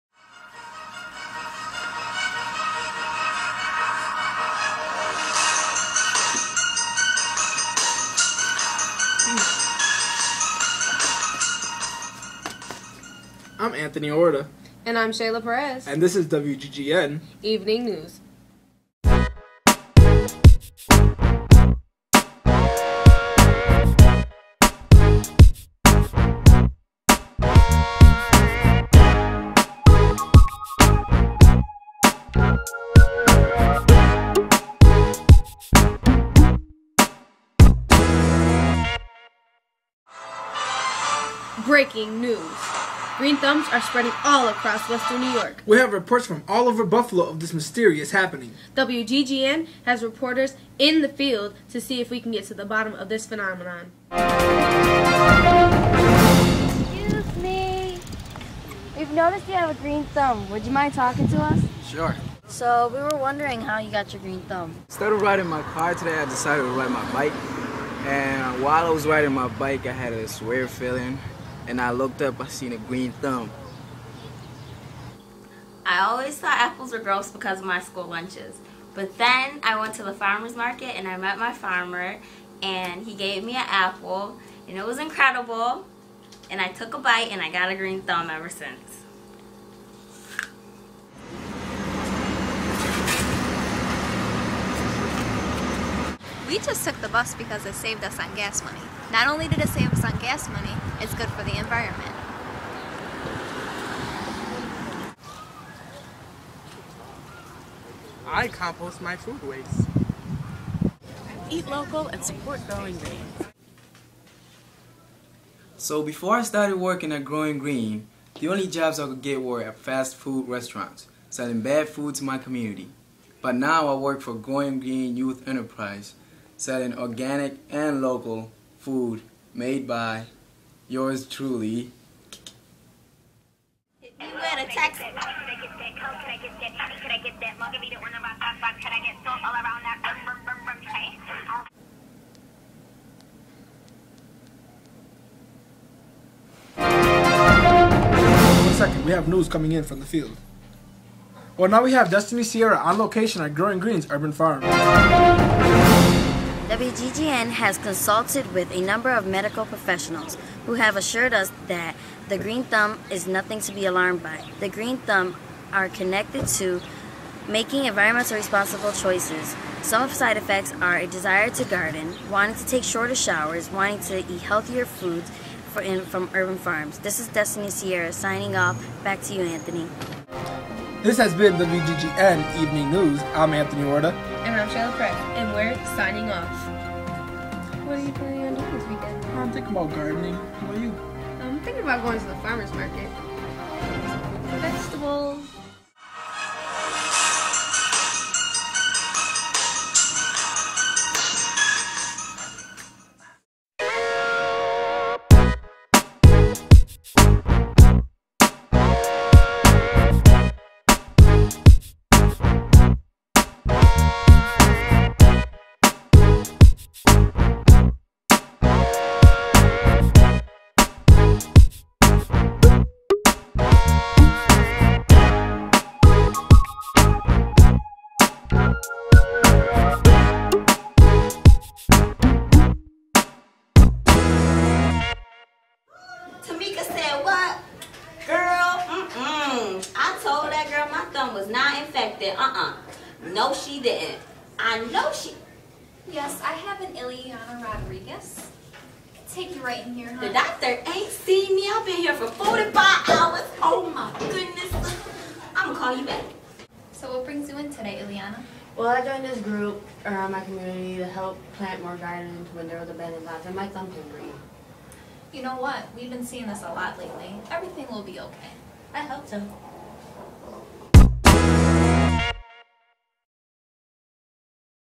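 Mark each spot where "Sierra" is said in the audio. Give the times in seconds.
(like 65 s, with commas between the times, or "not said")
152 s, 177 s.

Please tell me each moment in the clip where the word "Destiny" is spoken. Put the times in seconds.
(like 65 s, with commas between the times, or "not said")
152 s, 177 s.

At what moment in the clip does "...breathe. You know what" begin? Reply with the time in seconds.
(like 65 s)
264 s.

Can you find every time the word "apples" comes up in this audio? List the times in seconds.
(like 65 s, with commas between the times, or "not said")
76 s, 83 s.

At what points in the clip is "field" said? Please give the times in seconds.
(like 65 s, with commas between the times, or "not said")
51 s, 150 s.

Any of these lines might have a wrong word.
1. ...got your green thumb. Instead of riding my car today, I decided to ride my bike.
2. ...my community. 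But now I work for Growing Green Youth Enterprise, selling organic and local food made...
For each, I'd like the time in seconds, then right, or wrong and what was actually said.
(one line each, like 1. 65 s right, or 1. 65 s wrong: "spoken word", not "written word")
1. 63 s right
2. 122 s right.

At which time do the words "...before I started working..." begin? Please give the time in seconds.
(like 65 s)
116 s.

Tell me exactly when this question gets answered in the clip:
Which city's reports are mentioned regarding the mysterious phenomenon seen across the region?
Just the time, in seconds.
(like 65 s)
46 s.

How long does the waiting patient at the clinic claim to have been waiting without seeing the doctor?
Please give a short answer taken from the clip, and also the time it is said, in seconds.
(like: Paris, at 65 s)
45 hours, at 252 s.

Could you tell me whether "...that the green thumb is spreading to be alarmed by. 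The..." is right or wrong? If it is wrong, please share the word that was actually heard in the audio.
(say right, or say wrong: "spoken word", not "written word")
wrong: "nothing", not "spreading".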